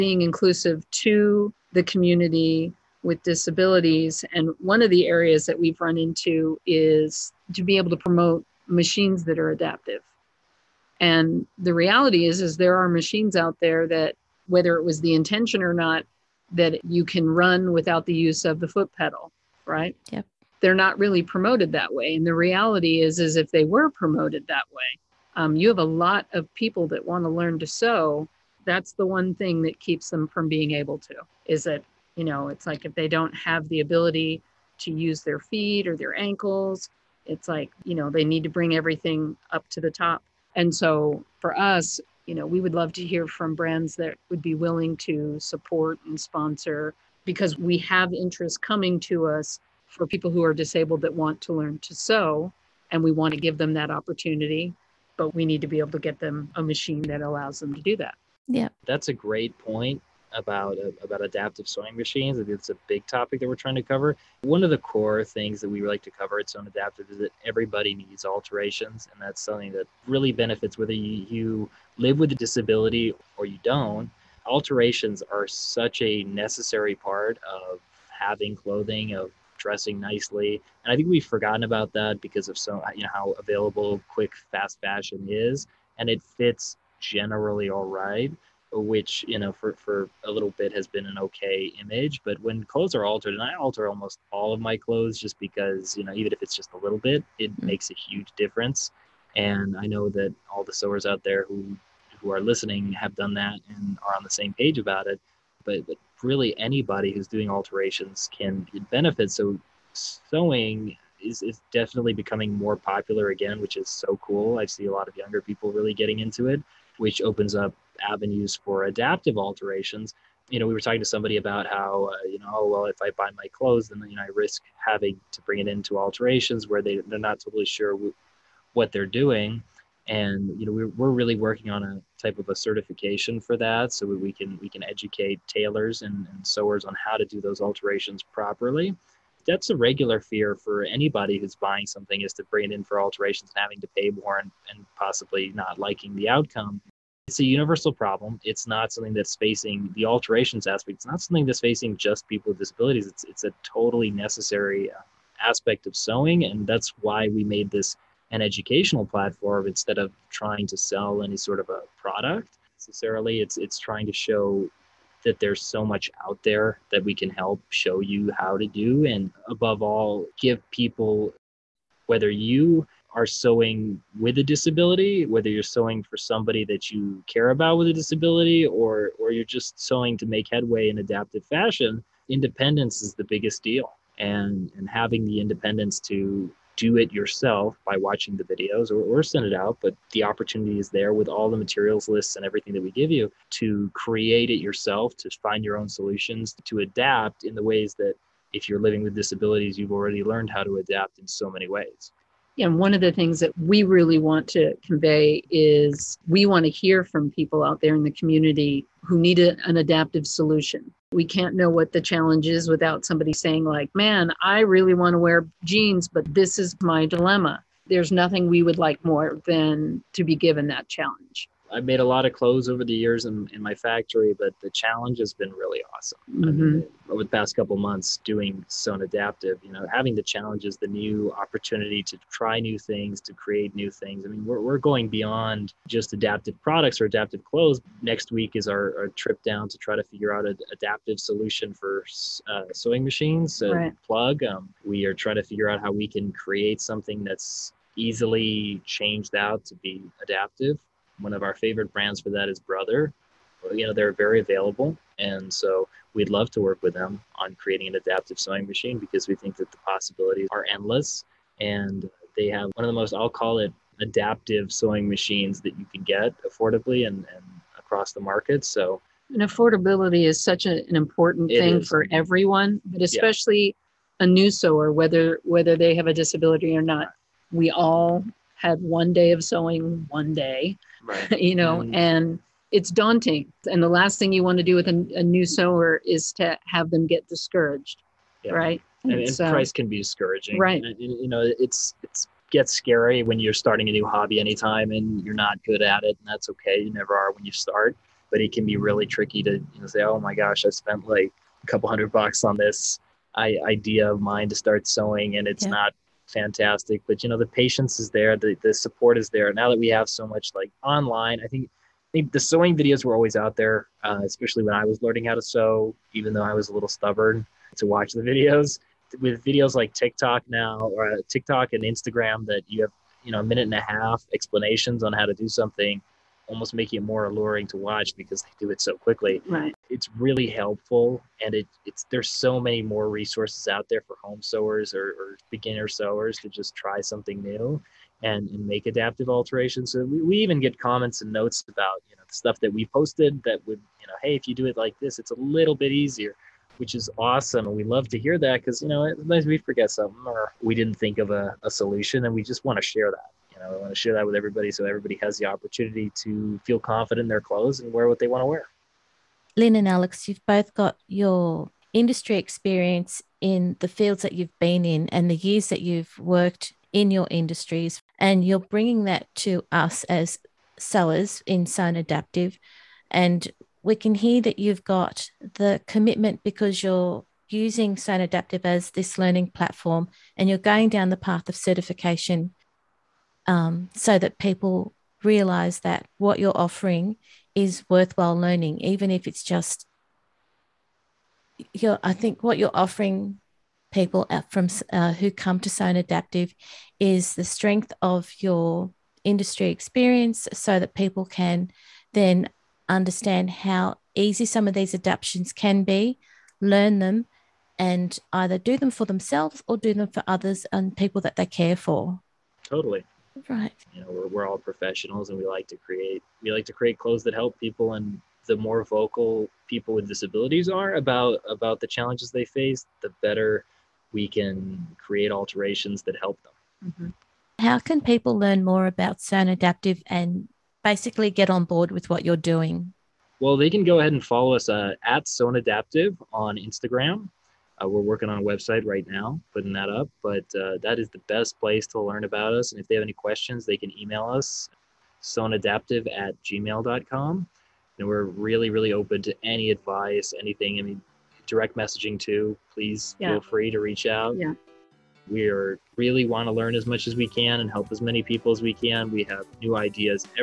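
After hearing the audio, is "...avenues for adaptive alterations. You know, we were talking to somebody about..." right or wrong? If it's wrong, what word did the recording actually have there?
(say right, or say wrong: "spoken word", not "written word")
right.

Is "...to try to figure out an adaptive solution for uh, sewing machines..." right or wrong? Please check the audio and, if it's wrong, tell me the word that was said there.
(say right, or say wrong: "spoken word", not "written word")
right.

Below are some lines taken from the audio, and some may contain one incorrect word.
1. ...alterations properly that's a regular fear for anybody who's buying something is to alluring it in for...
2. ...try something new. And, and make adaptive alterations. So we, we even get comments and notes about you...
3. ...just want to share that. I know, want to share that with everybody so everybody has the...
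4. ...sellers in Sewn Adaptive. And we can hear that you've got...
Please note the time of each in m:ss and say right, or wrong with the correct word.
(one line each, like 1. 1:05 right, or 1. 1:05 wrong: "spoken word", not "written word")
1. 2:17 wrong: "bring", not "alluring"
2. 5:36 right
3. 5:52 right
4. 6:10 right.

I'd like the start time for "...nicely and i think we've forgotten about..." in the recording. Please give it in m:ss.
1:19.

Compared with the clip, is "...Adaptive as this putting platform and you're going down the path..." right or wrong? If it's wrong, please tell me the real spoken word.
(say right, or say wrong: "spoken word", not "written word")
wrong: "learning", not "putting".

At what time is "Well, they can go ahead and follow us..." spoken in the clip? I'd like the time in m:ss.
7:13.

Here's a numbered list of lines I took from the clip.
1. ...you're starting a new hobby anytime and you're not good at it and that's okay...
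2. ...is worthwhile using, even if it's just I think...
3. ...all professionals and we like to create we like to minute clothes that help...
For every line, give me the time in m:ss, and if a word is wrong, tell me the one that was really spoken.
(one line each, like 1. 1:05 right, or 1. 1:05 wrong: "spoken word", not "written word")
1. 4:53 right
2. 6:27 wrong: "learning", not "using"
3. 6:54 wrong: "create", not "minute".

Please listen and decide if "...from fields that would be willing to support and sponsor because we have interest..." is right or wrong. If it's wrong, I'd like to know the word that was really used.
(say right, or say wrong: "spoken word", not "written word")
wrong: "brands", not "fields".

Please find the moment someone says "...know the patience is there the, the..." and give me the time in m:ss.
5:07.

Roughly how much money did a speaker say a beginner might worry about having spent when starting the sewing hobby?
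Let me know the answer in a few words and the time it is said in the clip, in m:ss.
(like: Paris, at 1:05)
a couple hundred bucks, at 5:01.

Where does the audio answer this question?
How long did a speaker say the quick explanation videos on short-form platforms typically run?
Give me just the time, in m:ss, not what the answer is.
5:23.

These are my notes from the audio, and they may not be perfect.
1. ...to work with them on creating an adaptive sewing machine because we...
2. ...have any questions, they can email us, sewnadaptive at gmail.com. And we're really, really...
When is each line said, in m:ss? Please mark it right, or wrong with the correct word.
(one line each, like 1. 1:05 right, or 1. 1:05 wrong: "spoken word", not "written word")
1. 4:16 right
2. 7:22 right.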